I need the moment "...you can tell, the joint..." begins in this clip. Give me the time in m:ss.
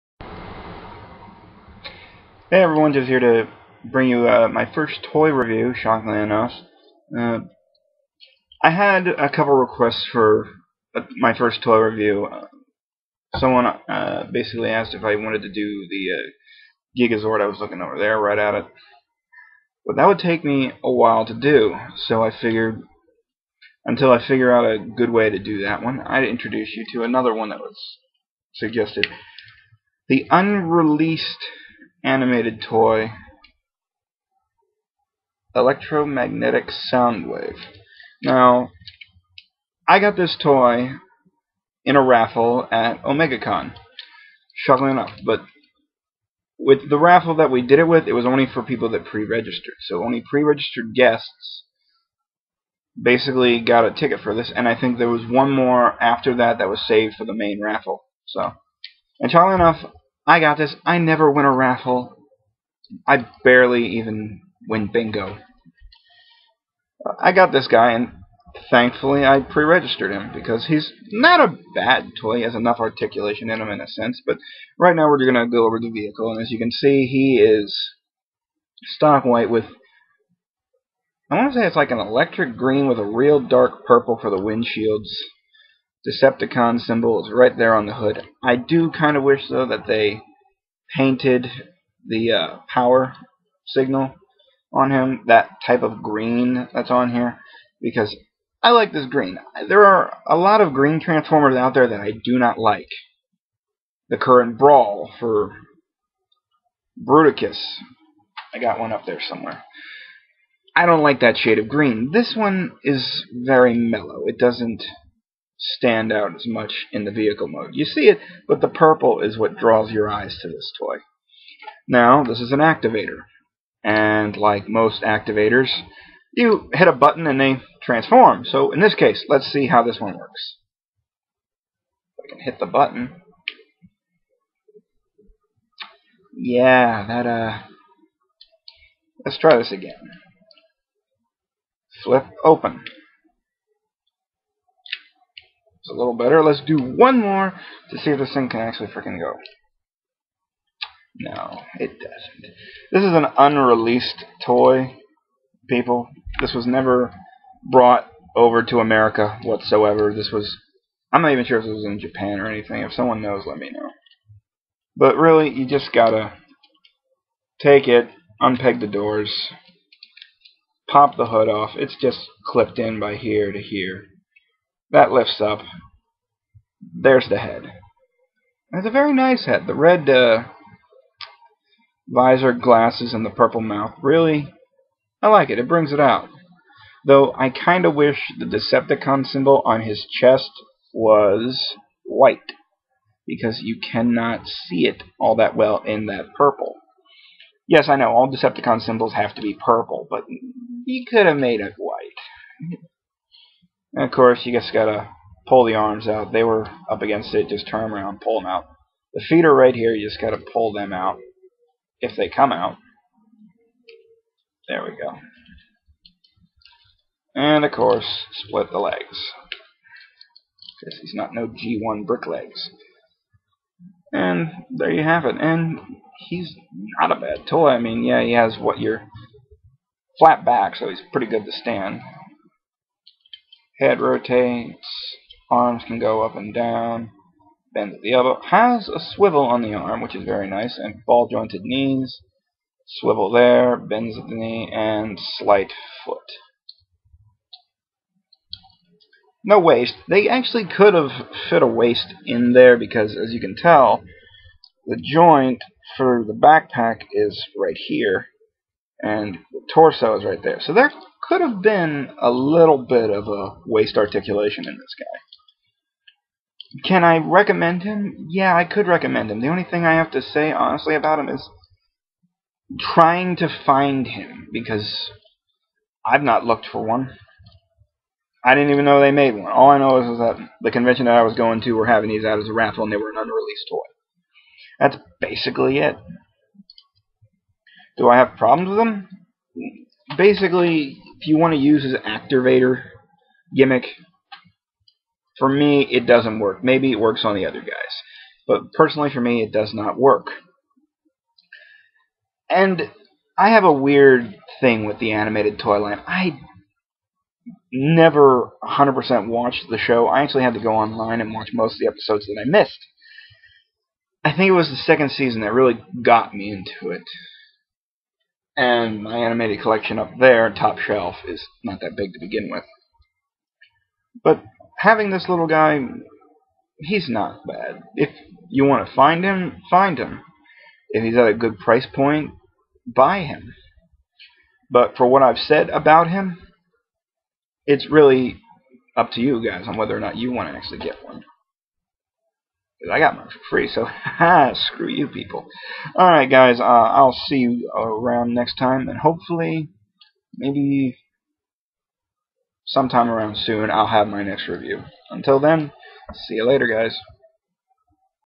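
4:13.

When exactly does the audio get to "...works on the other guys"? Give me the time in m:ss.
4:56.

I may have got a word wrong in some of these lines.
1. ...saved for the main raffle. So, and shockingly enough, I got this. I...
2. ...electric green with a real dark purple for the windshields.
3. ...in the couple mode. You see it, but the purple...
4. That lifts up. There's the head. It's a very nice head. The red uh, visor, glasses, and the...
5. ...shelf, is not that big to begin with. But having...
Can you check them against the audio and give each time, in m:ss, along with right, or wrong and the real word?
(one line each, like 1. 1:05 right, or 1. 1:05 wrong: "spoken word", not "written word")
1. 0:56 right
2. 1:21 right
3. 1:56 wrong: "vehicle", not "couple"
4. 2:54 right
5. 5:20 right.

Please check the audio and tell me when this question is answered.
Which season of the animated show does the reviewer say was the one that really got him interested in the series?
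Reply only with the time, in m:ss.
5:14.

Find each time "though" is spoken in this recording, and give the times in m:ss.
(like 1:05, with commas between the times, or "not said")
1:29, 3:07.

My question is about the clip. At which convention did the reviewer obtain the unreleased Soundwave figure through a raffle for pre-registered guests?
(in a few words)
OmegaCon.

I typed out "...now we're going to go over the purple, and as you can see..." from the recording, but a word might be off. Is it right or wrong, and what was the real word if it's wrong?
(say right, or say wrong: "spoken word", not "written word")
wrong: "vehicle", not "purple".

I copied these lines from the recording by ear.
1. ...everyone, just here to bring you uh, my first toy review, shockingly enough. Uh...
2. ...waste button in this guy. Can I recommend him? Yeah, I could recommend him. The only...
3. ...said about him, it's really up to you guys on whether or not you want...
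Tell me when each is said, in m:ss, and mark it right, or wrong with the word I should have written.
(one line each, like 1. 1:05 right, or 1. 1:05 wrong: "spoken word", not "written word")
1. 0:02 right
2. 4:23 wrong: "articulation", not "button"
3. 5:35 right.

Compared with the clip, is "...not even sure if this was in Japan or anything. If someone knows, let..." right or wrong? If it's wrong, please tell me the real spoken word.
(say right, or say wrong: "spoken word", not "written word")
right.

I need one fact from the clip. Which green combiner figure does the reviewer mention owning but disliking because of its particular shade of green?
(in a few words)
Bruticus.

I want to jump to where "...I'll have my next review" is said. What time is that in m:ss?
5:53.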